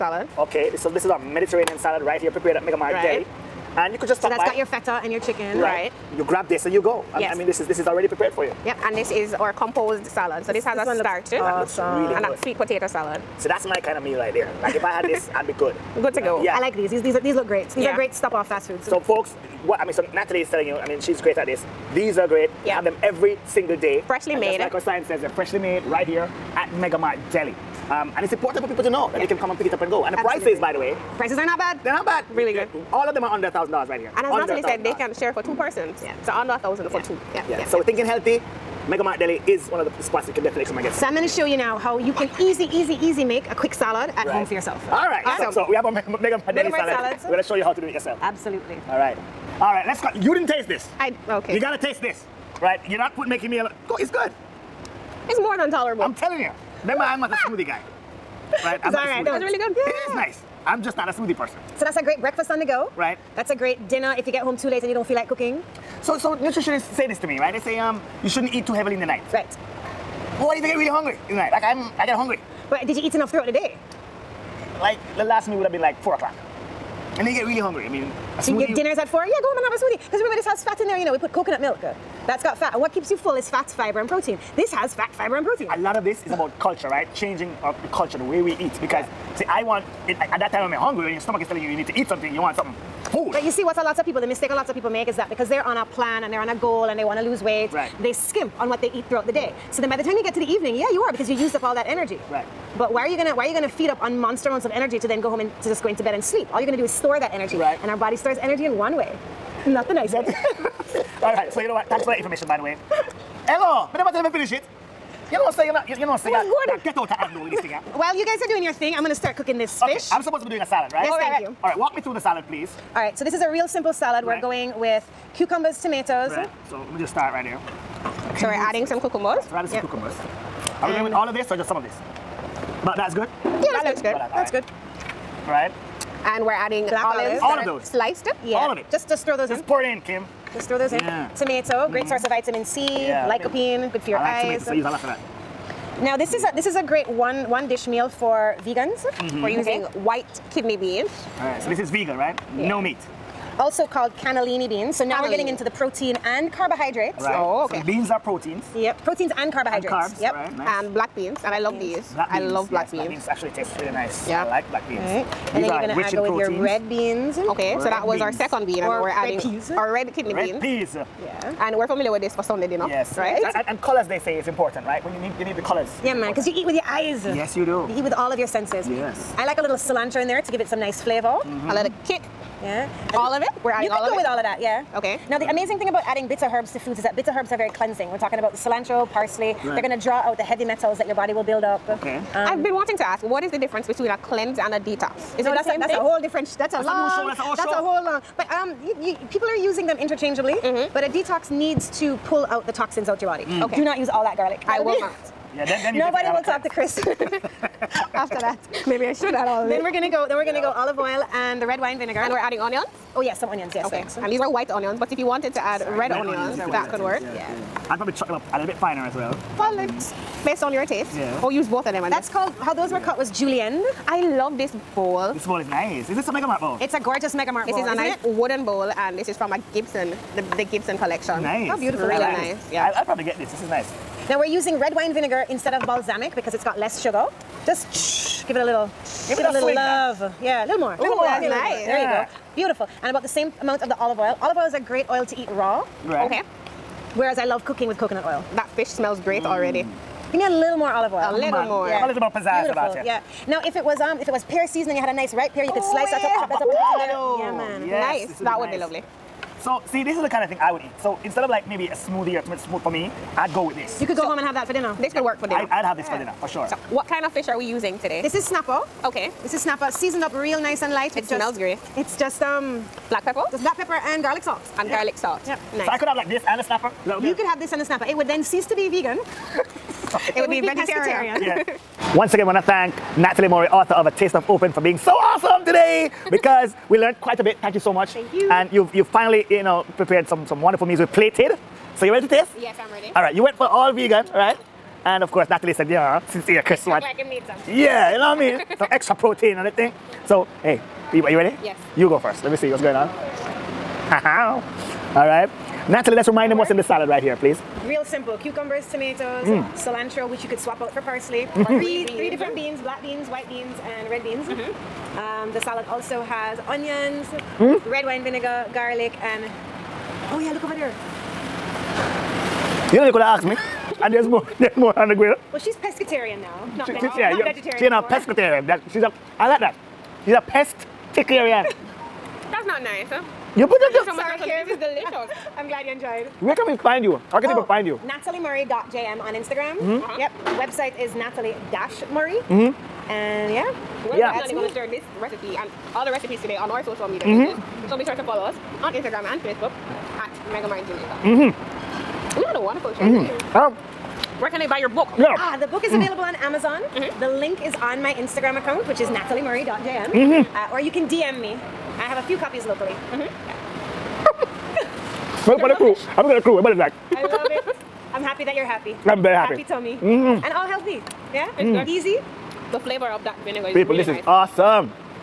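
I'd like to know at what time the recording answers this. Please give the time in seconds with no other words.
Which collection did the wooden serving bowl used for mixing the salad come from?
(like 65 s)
230 s.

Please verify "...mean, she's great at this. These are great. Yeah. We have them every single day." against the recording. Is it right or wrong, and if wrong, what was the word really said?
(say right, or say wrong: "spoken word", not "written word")
right.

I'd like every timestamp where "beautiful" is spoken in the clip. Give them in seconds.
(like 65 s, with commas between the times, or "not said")
231 s, 242 s, 252 s.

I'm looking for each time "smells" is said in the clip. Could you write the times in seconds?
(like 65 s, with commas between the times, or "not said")
248 s, 271 s.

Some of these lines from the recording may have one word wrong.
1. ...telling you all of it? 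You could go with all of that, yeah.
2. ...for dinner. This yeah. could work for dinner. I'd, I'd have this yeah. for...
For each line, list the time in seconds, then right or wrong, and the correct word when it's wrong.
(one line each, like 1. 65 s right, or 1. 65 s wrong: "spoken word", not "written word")
1. 183 s wrong: "adding", not "telling"
2. 264 s right.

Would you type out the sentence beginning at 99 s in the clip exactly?
So then by the time you get to the evening, yeah, you are because you used up all that energy.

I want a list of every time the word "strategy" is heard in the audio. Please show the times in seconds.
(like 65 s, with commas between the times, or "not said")
not said.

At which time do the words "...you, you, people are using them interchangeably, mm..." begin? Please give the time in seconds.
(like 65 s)
198 s.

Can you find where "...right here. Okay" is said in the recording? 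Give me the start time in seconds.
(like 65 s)
127 s.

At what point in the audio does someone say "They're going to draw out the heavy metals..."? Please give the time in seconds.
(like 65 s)
189 s.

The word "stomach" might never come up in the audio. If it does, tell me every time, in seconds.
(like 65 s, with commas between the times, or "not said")
91 s.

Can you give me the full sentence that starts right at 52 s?
You're not putting making me a, it's good.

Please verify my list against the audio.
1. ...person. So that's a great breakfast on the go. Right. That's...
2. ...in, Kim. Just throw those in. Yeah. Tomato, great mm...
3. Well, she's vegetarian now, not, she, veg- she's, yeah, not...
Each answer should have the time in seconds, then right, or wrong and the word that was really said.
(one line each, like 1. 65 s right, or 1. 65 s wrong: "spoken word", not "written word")
1. 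61 s right
2. 139 s right
3. 325 s wrong: "pescatarian", not "vegetarian".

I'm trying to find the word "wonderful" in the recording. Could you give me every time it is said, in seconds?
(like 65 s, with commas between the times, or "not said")
290 s, 352 s.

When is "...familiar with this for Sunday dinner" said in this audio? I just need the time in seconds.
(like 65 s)
171 s.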